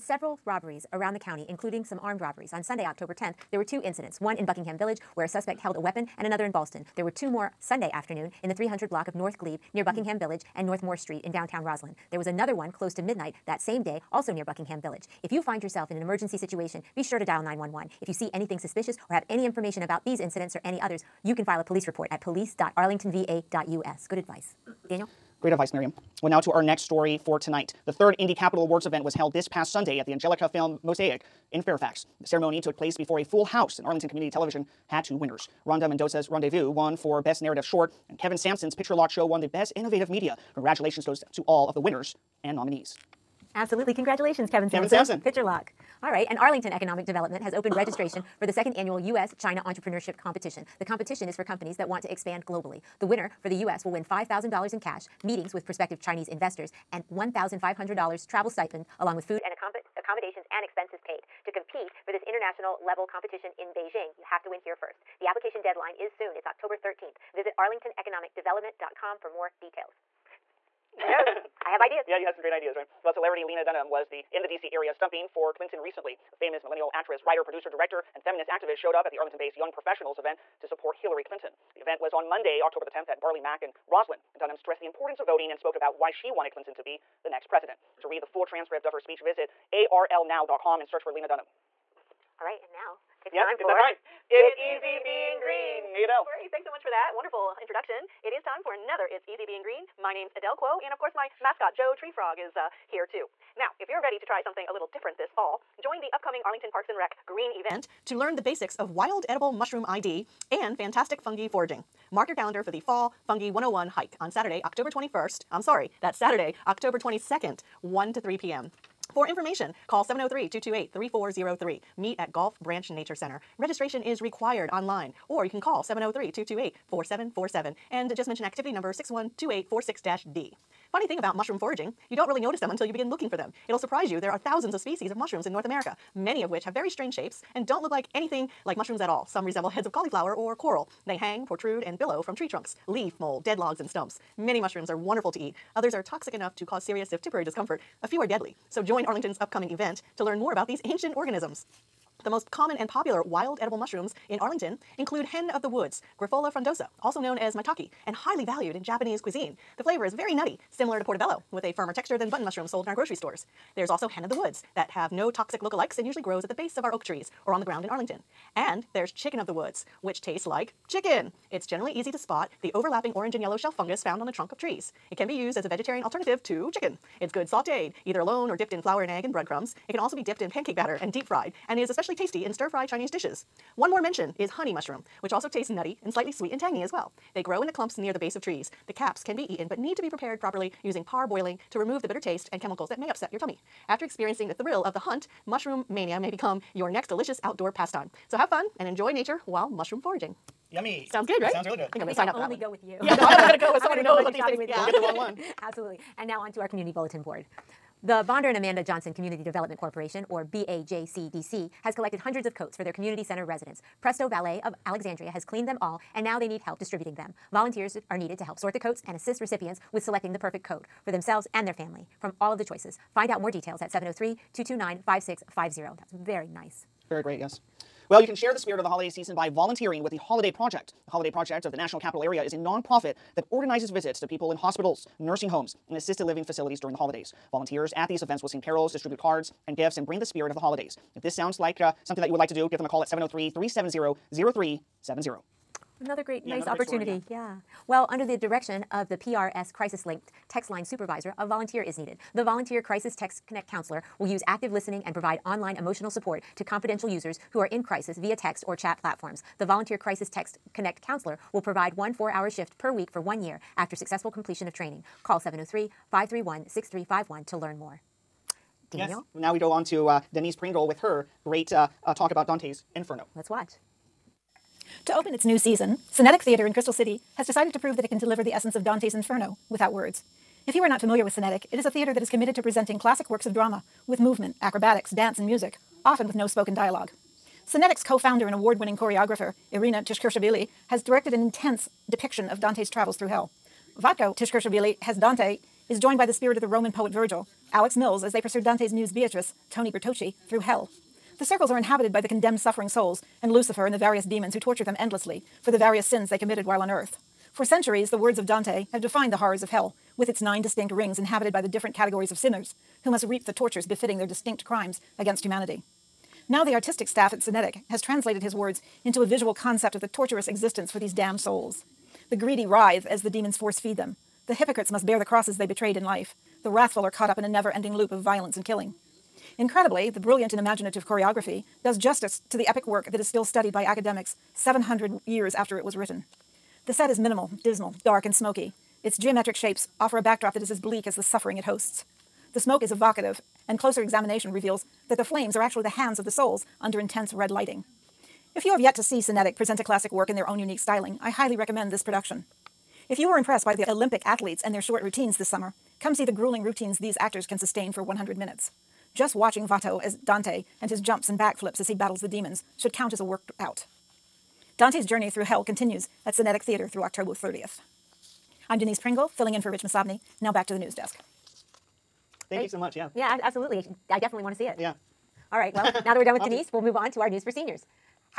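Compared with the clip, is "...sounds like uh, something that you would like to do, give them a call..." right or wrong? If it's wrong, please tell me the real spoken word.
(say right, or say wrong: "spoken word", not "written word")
right.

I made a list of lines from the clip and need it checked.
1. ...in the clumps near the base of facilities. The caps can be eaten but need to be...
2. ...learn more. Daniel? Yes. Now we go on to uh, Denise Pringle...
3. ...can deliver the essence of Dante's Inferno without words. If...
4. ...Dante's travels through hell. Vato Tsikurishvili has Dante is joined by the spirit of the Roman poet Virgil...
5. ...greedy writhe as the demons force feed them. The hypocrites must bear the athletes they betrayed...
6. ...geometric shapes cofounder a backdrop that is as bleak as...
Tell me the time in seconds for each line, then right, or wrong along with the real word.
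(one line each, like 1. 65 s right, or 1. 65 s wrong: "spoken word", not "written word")
1. 187 s wrong: "trees", not "facilities"
2. 267 s right
3. 278 s right
4. 292 s right
5. 322 s wrong: "crosses", not "athletes"
6. 339 s wrong: "offer", not "cofounder".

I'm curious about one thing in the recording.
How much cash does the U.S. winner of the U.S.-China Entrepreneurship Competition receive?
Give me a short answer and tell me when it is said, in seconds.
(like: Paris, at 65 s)
$5,000, at 54 s.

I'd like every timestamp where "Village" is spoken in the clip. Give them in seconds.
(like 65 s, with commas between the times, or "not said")
4 s, 10 s, 14 s.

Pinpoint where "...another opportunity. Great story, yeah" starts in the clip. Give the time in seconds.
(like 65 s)
246 s.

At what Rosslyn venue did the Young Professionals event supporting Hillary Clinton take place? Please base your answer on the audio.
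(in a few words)
Barley Mack.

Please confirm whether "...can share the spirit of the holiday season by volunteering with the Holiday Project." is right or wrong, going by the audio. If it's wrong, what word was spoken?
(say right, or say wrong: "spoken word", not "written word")
right.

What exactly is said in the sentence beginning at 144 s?
Many mushrooms are wonderful to eat.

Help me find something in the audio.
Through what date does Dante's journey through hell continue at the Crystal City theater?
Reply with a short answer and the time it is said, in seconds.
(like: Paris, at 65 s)
October 30th, at 367 s.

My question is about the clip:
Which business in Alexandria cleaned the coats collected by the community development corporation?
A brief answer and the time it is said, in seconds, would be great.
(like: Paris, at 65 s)
Presto Valet, at 214 s.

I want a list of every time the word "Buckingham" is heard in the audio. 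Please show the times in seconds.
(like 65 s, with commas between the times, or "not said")
4 s, 9 s, 14 s.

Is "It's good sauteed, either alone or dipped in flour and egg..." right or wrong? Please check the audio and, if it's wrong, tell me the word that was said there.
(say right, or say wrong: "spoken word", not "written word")
right.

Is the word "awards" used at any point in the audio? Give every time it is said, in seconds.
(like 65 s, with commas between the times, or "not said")
28 s, 288 s.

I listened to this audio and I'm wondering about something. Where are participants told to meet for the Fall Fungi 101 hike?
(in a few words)
Gulf Branch Nature Center.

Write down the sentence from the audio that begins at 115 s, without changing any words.
I'm sorry, that's Saturday, October 22nd, 1 to 3 p.m.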